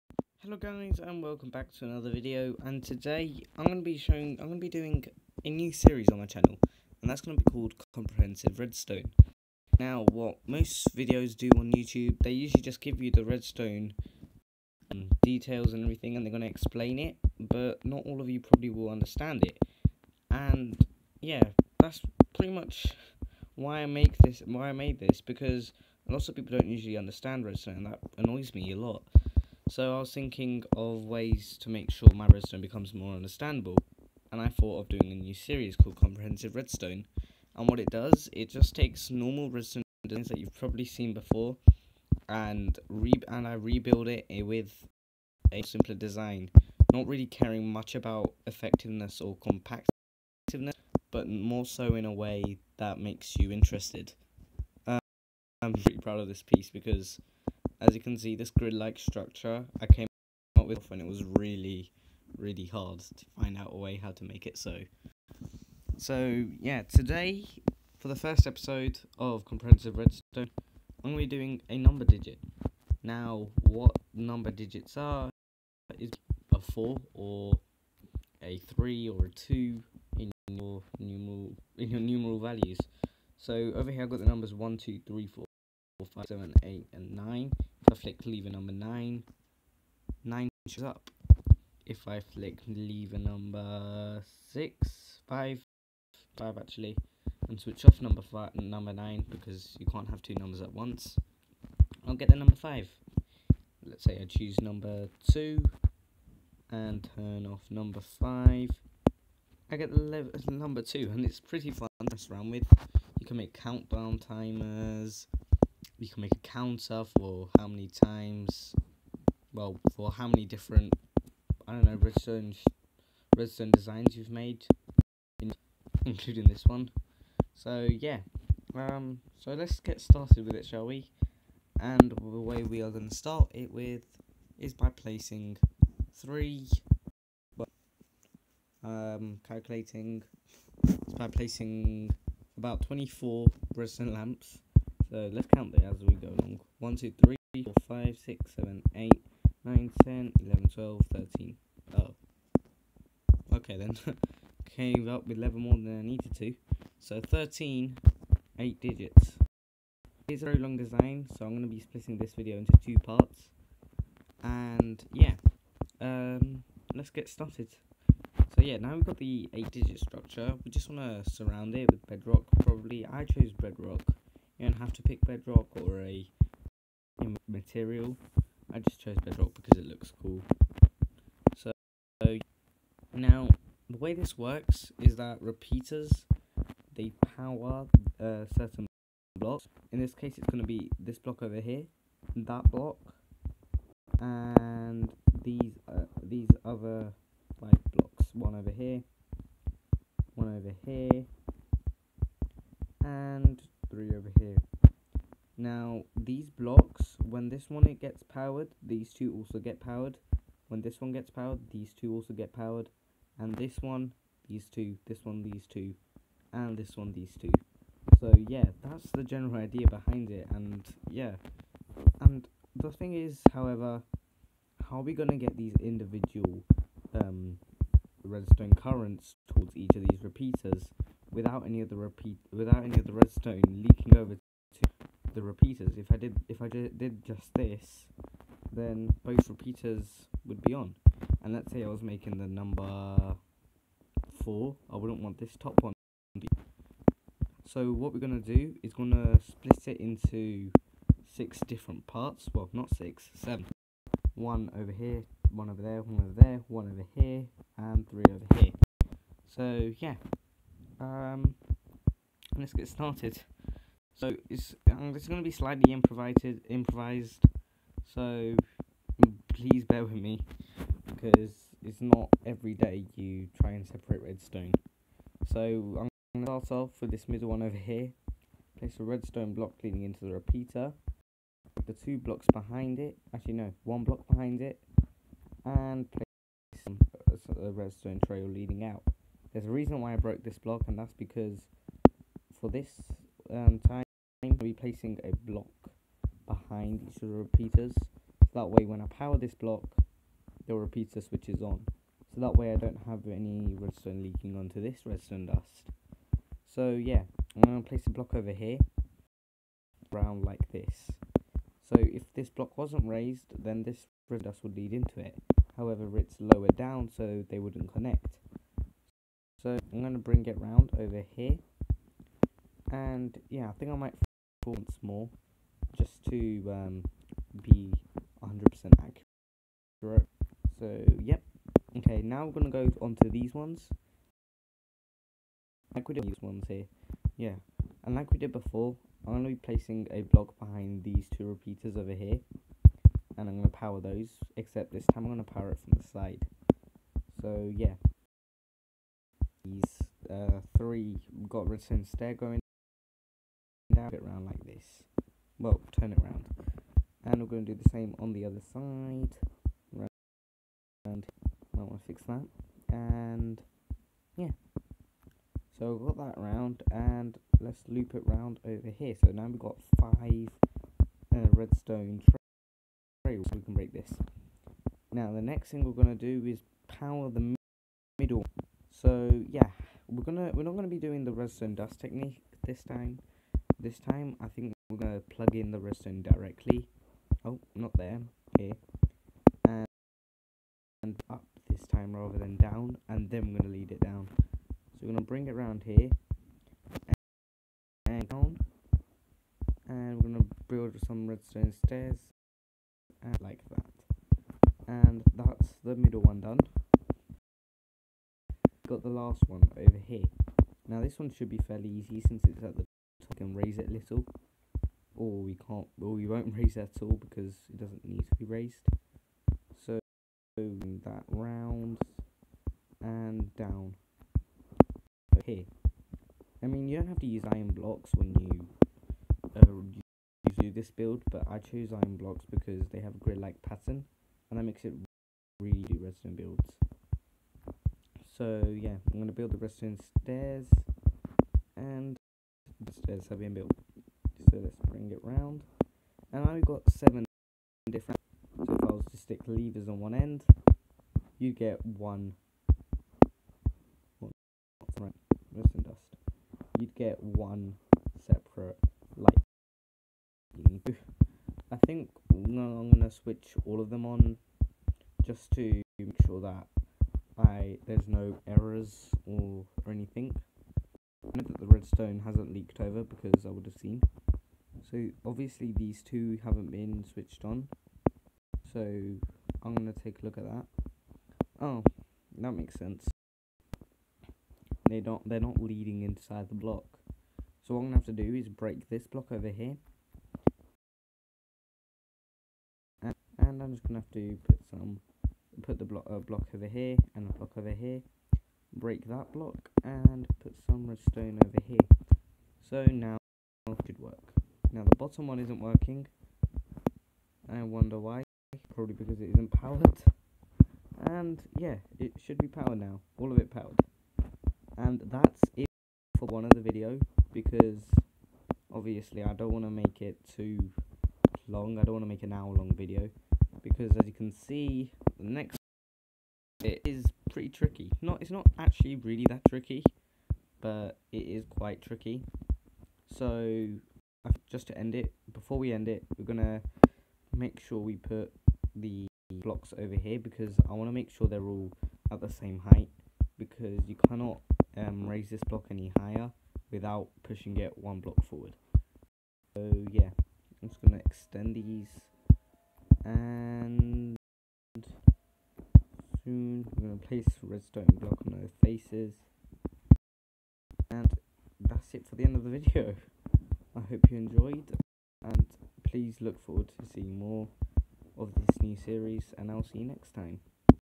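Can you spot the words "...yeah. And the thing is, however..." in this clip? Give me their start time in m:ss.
3:41.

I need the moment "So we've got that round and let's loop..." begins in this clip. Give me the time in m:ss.
6:05.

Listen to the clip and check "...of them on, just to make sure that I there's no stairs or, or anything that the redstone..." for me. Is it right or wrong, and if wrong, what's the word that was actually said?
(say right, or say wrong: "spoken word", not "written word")
wrong: "errors", not "stairs".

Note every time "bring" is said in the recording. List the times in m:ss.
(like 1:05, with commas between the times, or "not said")
5:20, 6:35, 7:24.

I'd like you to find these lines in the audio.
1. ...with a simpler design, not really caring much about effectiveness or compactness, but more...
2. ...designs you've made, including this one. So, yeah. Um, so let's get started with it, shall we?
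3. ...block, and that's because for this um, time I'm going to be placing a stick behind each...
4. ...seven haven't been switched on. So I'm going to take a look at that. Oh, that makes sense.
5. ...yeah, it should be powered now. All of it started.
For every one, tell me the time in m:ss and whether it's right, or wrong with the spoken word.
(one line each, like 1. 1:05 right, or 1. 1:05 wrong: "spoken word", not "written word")
1. 0:44 right
2. 2:03 right
3. 4:50 wrong: "block", not "stick"
4. 7:56 wrong: "two", not "seven"
5. 8:31 wrong: "powered", not "started".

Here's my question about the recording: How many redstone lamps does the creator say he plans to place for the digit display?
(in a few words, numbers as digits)
24.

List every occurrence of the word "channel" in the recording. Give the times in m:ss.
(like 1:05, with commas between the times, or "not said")
0:06.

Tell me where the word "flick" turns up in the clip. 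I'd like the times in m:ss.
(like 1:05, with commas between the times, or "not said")
1:27, 1:32.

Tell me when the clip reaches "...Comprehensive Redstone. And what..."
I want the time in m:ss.
0:35.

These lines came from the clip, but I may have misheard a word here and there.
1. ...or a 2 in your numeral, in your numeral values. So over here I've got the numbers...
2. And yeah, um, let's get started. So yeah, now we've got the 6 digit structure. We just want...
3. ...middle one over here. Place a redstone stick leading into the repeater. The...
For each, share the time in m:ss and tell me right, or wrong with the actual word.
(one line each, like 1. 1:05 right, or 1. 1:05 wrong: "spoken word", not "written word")
1. 1:19 right
2. 2:44 wrong: "8", not "6"
3. 4:37 wrong: "block", not "stick".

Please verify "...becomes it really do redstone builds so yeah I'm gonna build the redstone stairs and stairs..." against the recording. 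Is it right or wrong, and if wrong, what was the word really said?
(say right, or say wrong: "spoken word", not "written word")
wrong: "makes", not "becomes".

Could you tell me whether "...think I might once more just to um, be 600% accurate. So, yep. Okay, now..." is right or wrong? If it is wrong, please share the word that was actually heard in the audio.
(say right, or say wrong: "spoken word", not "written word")
wrong: "100", not "600".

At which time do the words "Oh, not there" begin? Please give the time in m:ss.
6:27.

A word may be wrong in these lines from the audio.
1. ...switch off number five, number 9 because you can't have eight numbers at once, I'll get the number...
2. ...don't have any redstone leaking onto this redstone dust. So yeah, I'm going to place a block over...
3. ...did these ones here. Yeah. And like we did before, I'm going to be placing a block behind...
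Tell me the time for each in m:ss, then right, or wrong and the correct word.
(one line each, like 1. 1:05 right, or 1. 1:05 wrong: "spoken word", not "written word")
1. 1:37 wrong: "two", not "eight"
2. 5:02 right
3. 5:36 right.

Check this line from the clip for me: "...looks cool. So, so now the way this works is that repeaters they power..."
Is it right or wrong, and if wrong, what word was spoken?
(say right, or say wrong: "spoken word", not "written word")
right.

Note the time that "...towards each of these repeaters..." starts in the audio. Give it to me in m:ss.
3:49.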